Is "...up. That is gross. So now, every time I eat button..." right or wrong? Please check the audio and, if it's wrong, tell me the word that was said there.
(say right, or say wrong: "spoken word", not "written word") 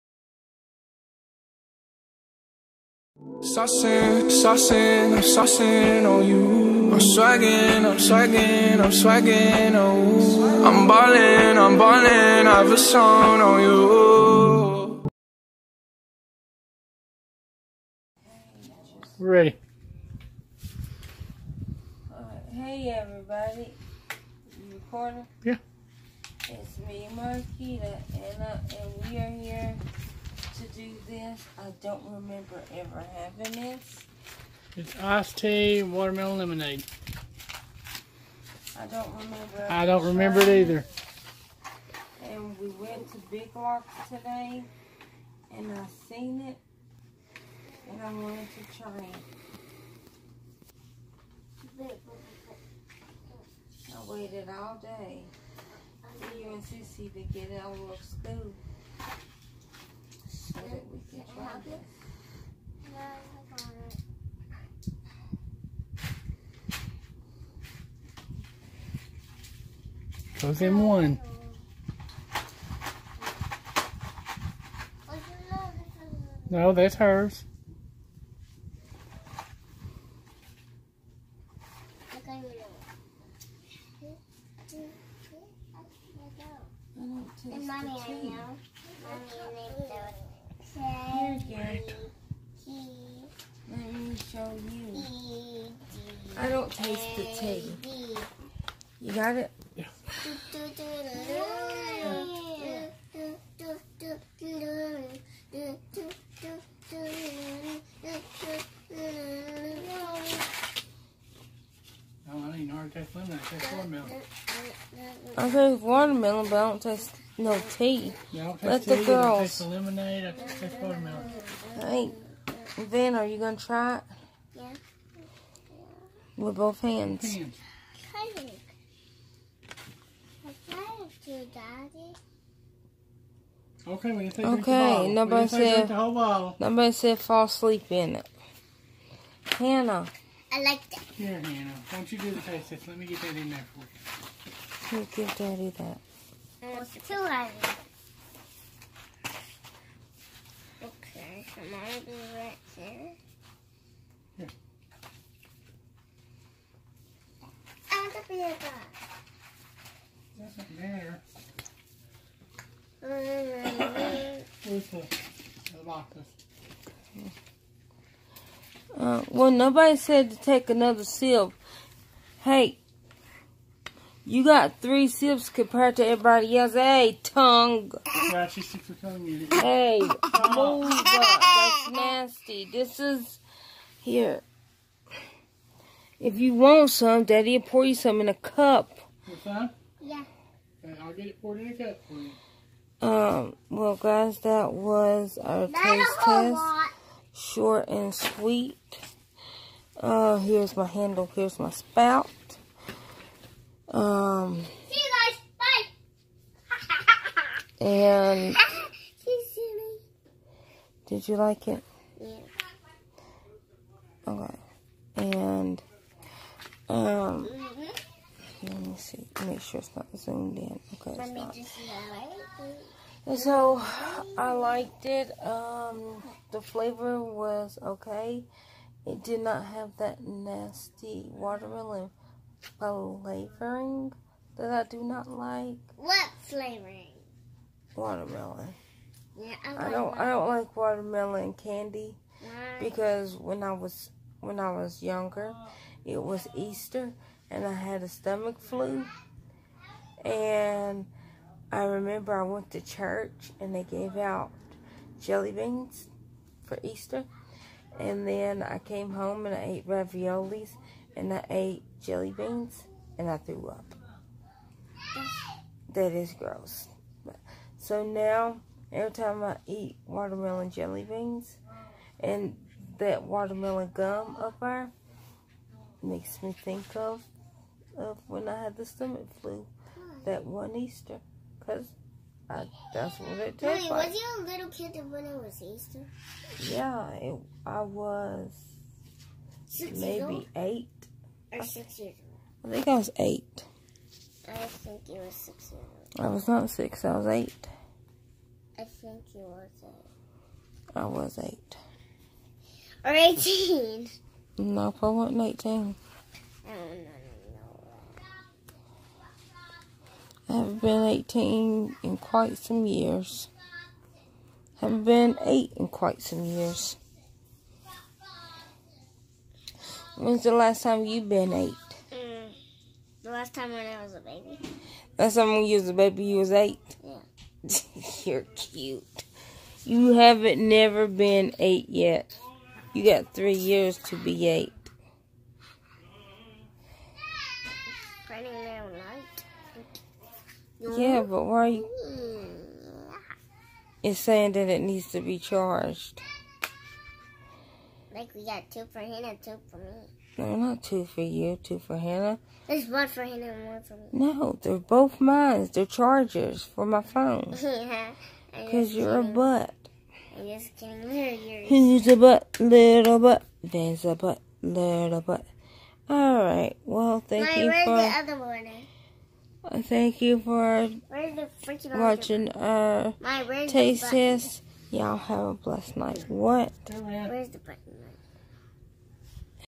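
wrong: "watermelon", not "button".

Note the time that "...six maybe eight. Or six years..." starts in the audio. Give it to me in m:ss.
4:49.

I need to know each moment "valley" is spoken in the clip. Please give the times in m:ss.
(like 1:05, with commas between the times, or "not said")
not said.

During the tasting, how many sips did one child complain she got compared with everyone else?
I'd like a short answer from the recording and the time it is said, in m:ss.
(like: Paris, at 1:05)
3, at 2:54.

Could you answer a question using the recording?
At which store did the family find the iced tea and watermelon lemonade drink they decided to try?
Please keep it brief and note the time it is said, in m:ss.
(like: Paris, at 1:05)
Big Lots, at 0:43.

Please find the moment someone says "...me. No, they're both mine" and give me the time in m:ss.
5:53.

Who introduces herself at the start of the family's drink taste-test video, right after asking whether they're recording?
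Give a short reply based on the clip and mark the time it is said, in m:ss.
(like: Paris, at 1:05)
Marquita, at 0:27.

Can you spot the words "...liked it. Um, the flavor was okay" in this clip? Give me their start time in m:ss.
3:44.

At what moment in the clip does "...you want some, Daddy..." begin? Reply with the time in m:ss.
3:06.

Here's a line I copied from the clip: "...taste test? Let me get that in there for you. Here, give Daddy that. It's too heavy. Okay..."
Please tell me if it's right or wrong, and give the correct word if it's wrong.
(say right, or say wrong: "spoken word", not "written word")
right.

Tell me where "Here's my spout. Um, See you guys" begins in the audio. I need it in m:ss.
3:21.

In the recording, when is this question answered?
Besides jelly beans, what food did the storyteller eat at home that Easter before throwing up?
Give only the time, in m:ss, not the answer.
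4:19.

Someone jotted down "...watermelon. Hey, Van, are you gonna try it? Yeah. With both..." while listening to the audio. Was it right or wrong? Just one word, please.
right.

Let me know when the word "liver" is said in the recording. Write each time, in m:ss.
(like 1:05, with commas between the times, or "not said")
not said.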